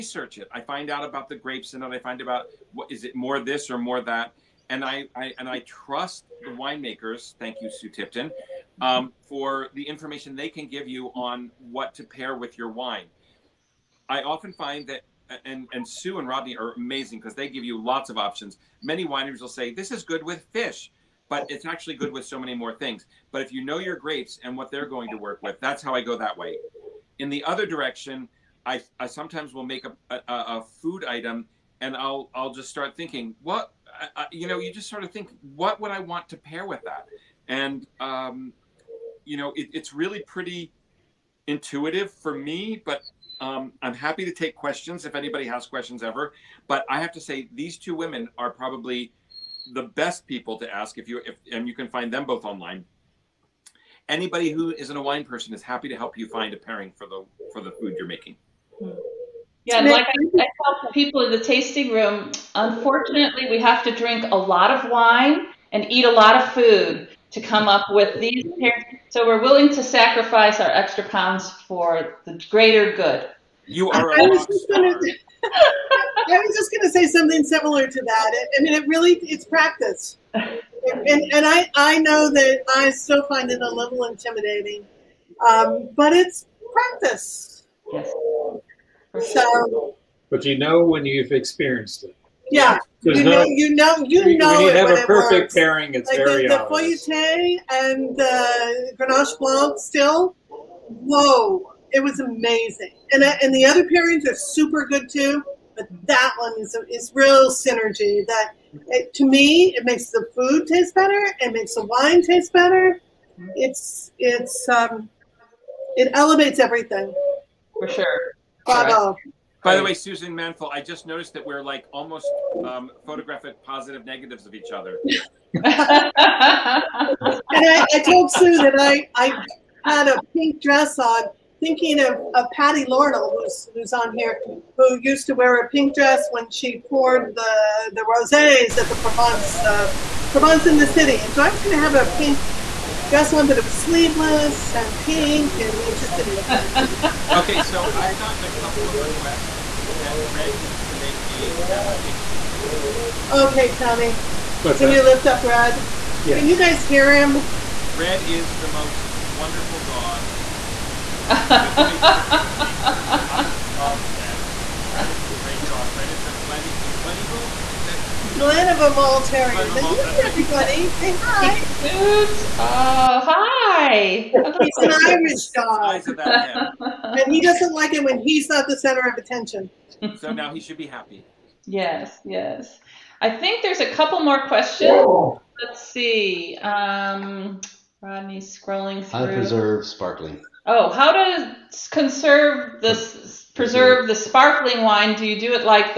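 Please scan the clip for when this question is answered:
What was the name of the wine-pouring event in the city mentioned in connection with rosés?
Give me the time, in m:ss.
2:20.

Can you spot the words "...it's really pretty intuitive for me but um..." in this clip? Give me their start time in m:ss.
0:39.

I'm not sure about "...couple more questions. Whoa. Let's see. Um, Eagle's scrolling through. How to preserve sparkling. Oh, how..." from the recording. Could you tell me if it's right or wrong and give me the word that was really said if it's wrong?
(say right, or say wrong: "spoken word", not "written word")
wrong: "Rodney", not "Eagle".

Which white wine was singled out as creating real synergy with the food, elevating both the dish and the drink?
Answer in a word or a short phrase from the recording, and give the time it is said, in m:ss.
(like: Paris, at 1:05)
Grenache Blanc, at 1:38.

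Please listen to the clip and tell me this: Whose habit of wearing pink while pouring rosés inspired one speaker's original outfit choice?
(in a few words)
Patty Lornell.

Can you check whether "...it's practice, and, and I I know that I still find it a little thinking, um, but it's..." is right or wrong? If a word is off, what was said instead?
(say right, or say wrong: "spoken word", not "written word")
wrong: "intimidating", not "thinking".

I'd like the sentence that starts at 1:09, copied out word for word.
So we're willing to sacrifice our extra pounds for the greater good.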